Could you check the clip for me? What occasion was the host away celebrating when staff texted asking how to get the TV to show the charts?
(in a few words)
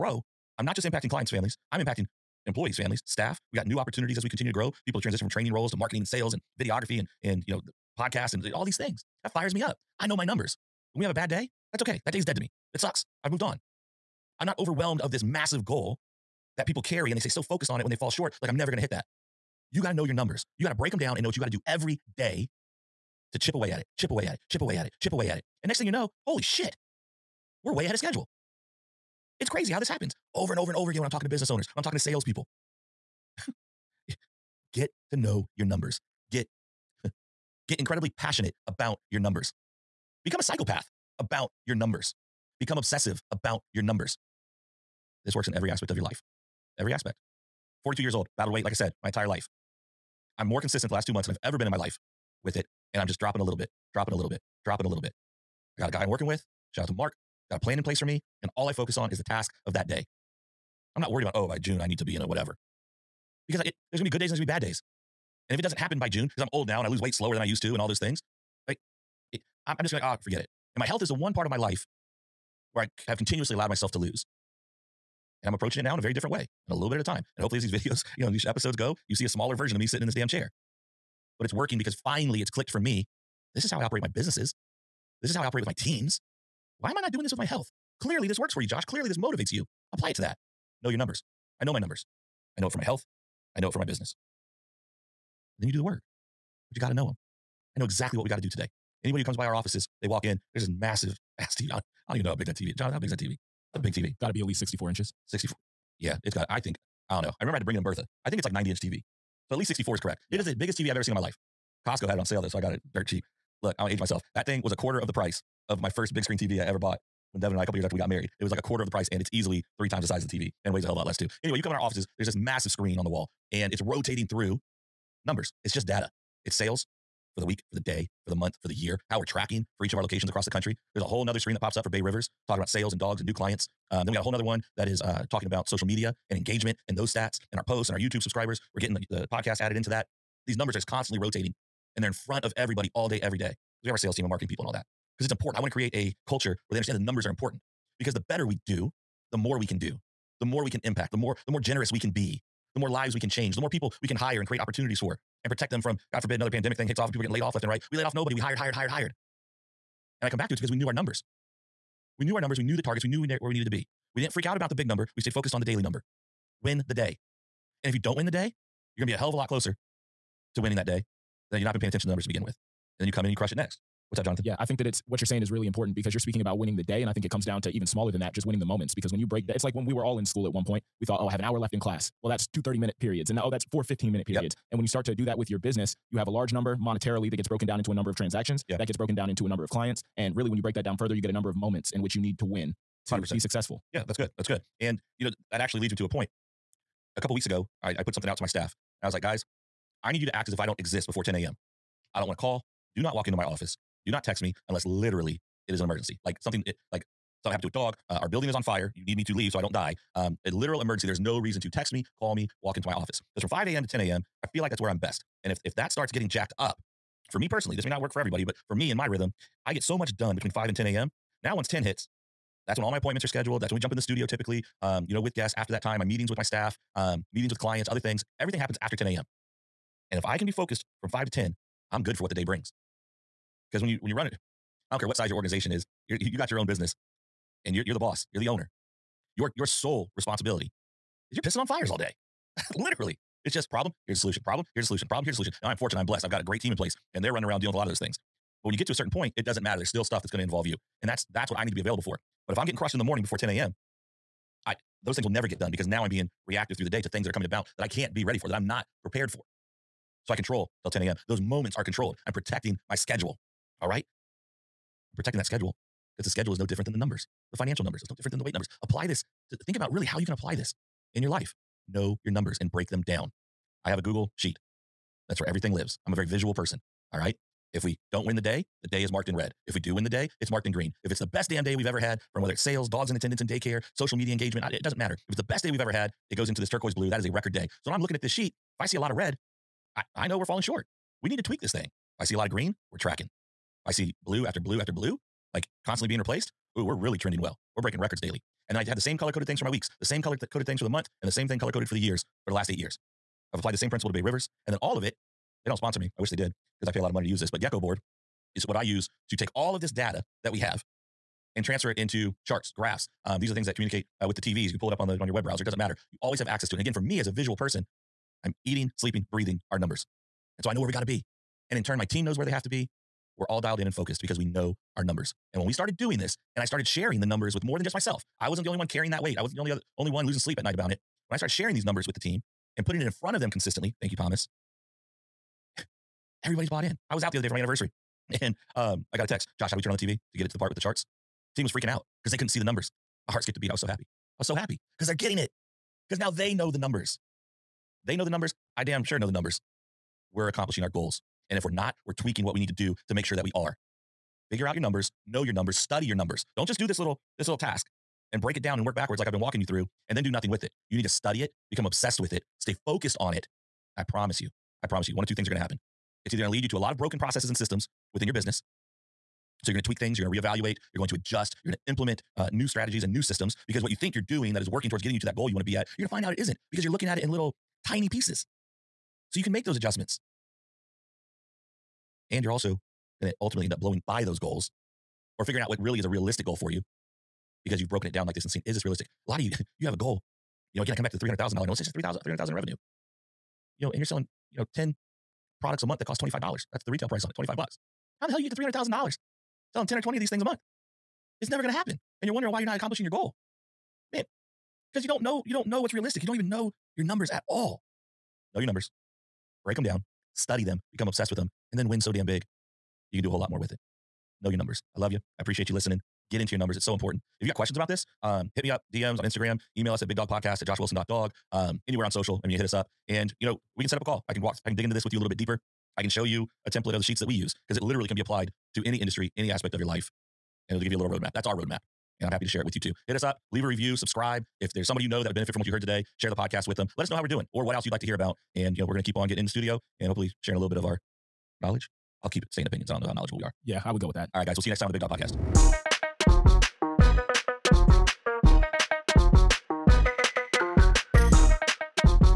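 anniversary.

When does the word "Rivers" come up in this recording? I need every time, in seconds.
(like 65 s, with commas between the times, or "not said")
132 s, 304 s.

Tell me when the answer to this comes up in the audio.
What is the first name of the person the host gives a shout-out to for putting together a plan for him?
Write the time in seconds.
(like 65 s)
56 s.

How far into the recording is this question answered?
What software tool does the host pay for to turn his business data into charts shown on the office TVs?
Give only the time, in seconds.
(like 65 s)
307 s.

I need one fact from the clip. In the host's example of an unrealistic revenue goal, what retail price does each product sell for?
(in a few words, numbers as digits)
$25.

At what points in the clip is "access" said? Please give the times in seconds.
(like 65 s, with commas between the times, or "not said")
316 s.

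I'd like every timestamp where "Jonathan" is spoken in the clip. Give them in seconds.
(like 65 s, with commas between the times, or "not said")
102 s, 174 s.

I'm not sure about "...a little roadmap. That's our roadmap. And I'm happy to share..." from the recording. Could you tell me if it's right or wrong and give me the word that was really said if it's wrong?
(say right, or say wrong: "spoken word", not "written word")
right.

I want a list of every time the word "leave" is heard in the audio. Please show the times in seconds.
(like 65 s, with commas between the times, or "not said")
209 s, 433 s.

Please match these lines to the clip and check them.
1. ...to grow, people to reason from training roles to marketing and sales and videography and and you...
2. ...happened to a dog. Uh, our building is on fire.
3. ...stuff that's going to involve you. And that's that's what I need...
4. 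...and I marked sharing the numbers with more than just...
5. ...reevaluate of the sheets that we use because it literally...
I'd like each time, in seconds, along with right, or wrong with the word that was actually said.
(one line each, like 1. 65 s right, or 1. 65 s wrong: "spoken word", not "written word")
1. 4 s wrong: "transition", not "reason"
2. 207 s right
3. 250 s right
4. 326 s wrong: "started", not "marked"
5. 426 s wrong: "template", not "reevaluate".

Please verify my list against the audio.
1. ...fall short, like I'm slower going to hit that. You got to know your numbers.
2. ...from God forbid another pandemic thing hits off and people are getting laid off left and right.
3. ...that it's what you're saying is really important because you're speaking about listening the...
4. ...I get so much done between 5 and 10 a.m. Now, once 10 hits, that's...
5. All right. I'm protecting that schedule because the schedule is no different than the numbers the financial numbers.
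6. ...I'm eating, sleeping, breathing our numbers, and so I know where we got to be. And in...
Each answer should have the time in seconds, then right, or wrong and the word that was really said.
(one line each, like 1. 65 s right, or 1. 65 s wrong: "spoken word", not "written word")
1. 17 s wrong: "never", not "slower"
2. 155 s right
3. 174 s wrong: "winning", not "listening"
4. 219 s right
5. 263 s right
6. 318 s right.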